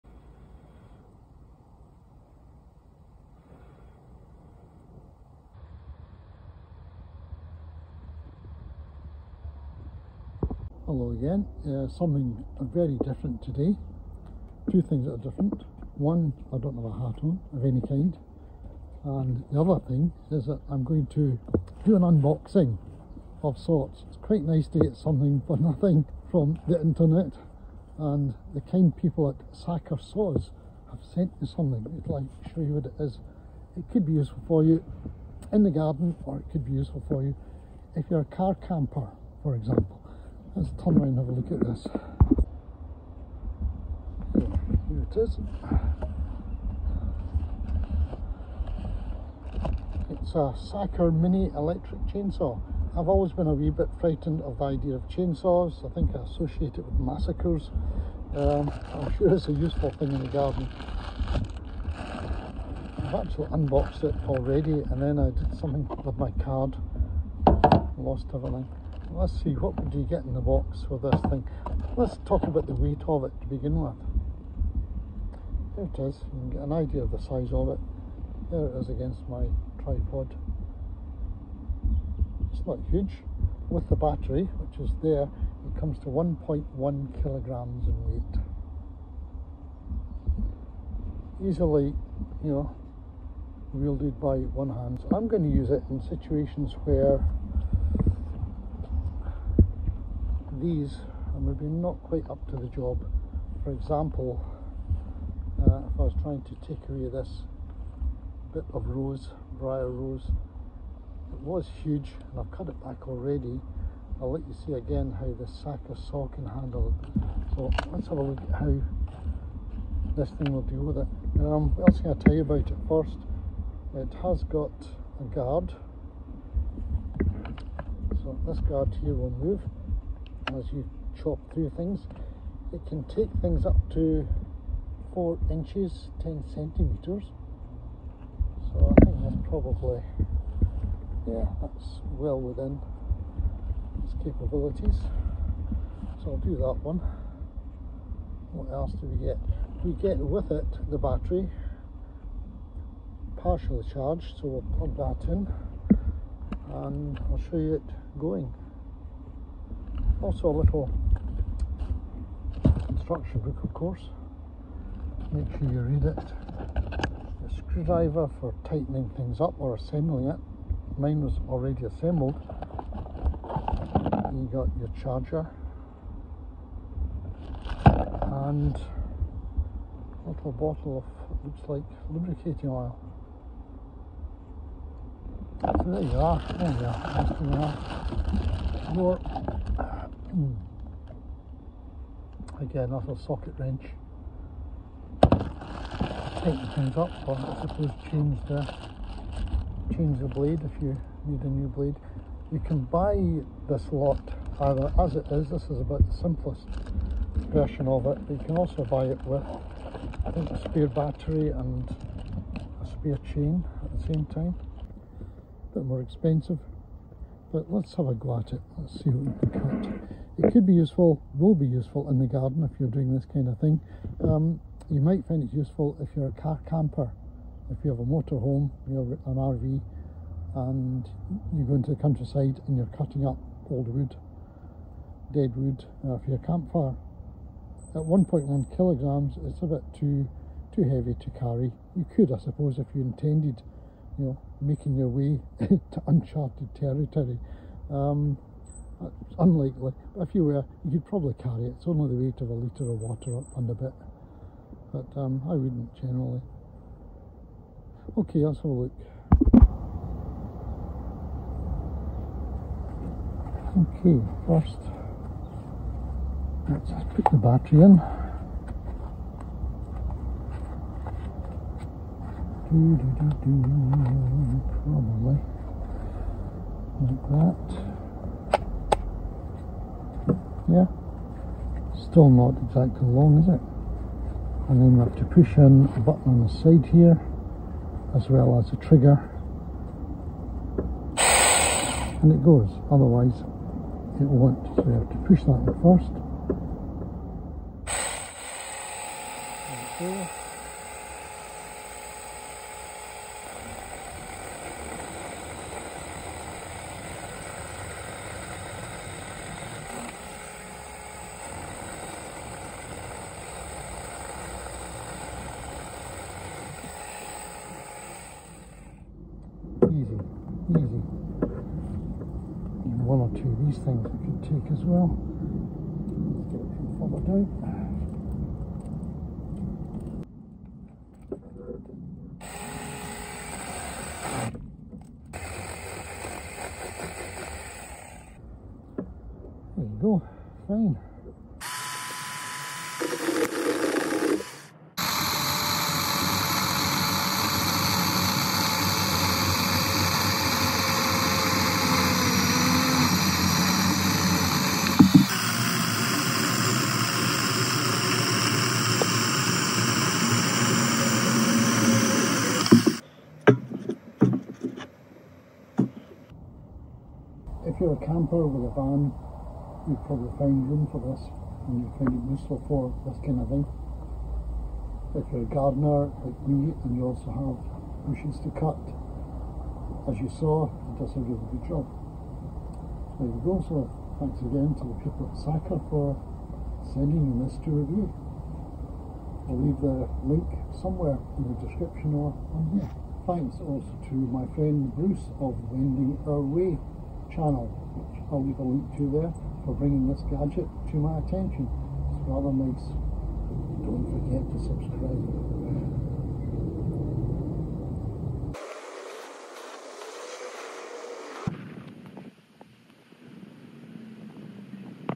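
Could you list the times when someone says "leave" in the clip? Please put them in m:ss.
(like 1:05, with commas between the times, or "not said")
6:29, 6:38.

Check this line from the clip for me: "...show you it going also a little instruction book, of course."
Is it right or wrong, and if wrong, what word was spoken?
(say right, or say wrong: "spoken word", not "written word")
right.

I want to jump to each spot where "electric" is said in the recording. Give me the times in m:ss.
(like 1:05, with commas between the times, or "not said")
0:51.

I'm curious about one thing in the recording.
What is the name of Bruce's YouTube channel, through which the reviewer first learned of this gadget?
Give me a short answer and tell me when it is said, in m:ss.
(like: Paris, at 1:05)
Wending Our Way, at 6:35.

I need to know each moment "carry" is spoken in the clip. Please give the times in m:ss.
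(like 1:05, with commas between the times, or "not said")
4:01, 4:11.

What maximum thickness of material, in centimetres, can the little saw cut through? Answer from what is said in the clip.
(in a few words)
10 centimeters.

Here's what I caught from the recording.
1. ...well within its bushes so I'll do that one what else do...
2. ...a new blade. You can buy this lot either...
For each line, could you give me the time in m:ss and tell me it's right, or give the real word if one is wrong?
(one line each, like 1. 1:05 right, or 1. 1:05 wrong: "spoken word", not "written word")
1. 2:22 wrong: "capabilities", not "bushes"
2. 3:21 right.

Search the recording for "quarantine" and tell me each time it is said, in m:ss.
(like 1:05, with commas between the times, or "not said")
not said.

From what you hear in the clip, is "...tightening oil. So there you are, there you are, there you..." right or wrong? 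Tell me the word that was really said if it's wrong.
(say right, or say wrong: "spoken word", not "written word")
wrong: "lubricating", not "tightening".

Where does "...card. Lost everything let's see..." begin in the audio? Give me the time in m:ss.
1:06.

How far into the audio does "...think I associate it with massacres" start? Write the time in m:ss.
0:55.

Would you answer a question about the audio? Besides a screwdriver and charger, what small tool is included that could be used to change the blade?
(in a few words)
Socket wrench.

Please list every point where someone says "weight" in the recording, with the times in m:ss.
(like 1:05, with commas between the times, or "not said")
1:12, 1:28, 4:12.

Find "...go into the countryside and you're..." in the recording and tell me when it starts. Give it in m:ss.
3:51.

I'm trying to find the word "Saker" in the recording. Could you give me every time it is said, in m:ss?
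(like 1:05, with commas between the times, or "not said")
0:29, 0:50, 6:25.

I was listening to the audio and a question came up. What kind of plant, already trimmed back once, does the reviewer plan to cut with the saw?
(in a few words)
Briar rose.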